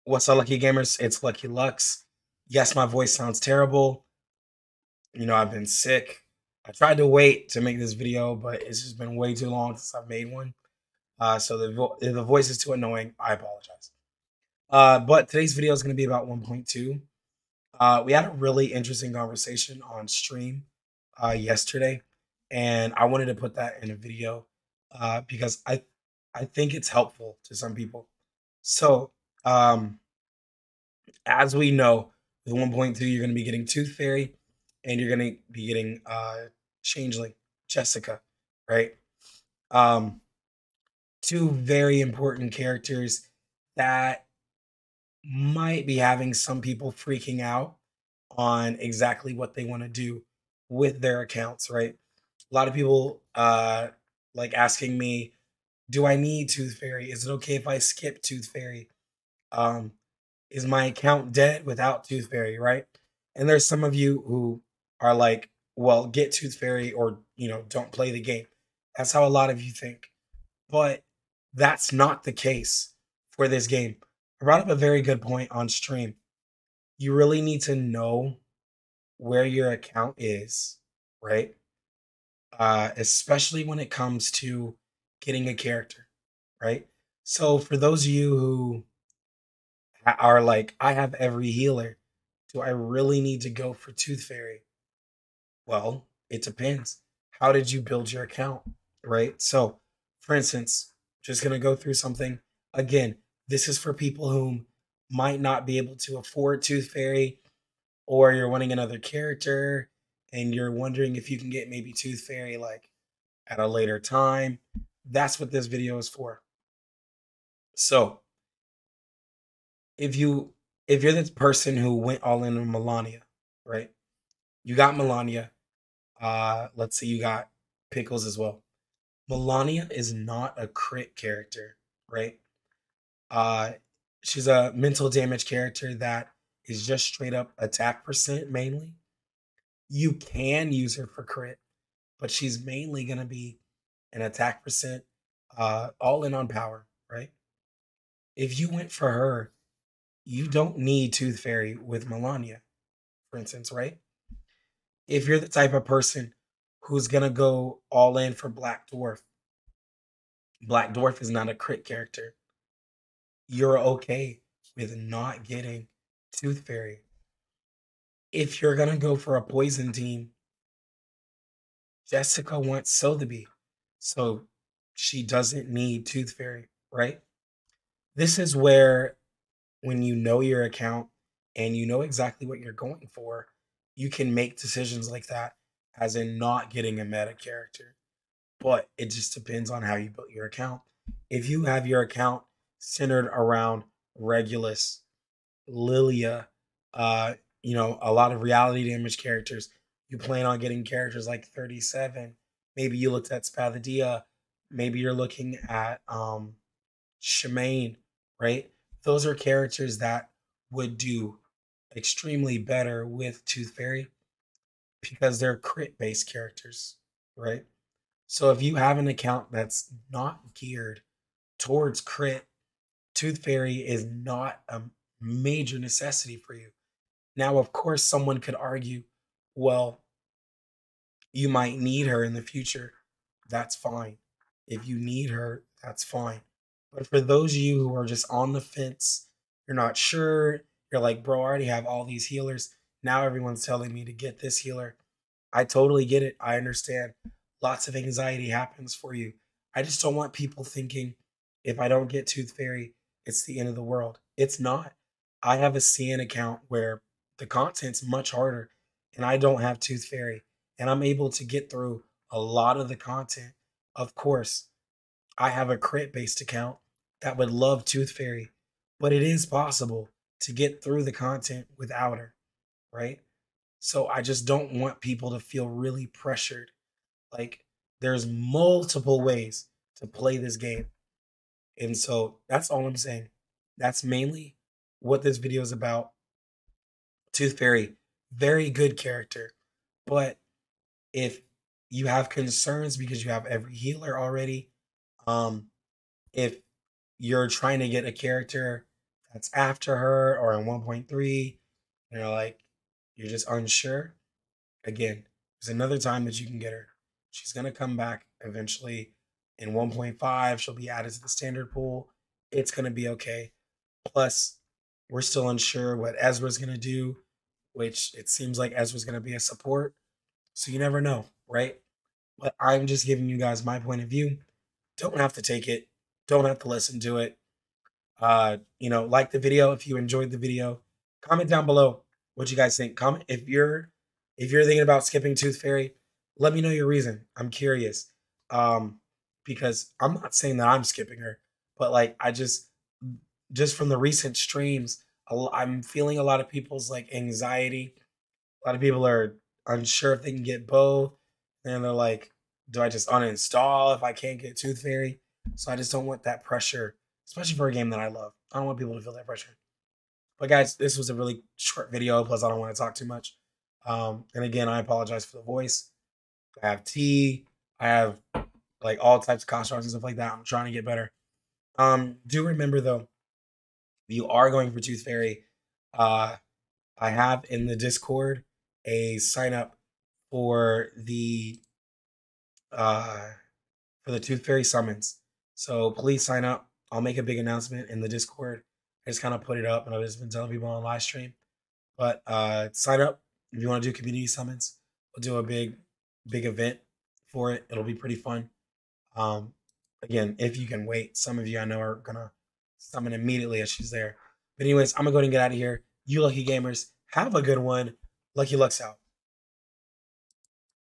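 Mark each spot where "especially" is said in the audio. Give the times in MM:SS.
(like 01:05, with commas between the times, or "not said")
01:22, 05:57.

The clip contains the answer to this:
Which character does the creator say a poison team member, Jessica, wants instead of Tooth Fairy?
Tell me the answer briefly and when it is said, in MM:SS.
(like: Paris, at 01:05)
Sotheby, at 02:52.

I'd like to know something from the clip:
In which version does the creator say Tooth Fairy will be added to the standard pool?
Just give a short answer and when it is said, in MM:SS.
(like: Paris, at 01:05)
1.5, at 05:09.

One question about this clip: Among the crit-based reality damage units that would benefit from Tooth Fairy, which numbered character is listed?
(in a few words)
37.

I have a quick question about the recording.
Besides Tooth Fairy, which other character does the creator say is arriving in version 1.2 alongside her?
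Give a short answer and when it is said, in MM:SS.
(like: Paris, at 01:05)
Changeling, at 00:36.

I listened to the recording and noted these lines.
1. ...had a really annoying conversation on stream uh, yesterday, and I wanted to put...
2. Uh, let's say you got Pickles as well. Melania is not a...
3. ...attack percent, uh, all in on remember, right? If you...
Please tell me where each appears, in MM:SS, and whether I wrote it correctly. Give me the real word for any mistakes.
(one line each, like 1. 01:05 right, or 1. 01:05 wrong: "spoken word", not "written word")
1. 00:18 wrong: "interesting", not "annoying"
2. 02:06 right
3. 02:24 wrong: "power", not "remember".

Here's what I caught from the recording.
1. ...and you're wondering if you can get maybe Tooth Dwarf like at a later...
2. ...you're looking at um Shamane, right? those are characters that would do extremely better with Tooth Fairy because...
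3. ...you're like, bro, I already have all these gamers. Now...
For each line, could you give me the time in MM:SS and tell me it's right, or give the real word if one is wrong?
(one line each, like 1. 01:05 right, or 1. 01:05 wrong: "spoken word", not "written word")
1. 01:50 wrong: "Fairy", not "Dwarf"
2. 03:24 right
3. 04:00 wrong: "healers", not "gamers".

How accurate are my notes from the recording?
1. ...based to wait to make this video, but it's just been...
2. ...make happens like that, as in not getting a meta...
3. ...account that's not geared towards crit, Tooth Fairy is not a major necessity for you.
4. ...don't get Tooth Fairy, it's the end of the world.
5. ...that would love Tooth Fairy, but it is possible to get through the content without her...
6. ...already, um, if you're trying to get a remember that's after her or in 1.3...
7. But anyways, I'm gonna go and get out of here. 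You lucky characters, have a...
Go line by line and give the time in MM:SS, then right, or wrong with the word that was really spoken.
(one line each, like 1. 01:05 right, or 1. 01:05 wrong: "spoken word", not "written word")
1. 00:06 wrong: "tried", not "based"
2. 03:04 wrong: "decisions", not "happens"
3. 03:39 right
4. 04:11 right
5. 04:27 right
6. 04:54 wrong: "character", not "remember"
7. 06:44 wrong: "gamers", not "characters".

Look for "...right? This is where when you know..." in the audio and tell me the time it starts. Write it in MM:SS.
02:56.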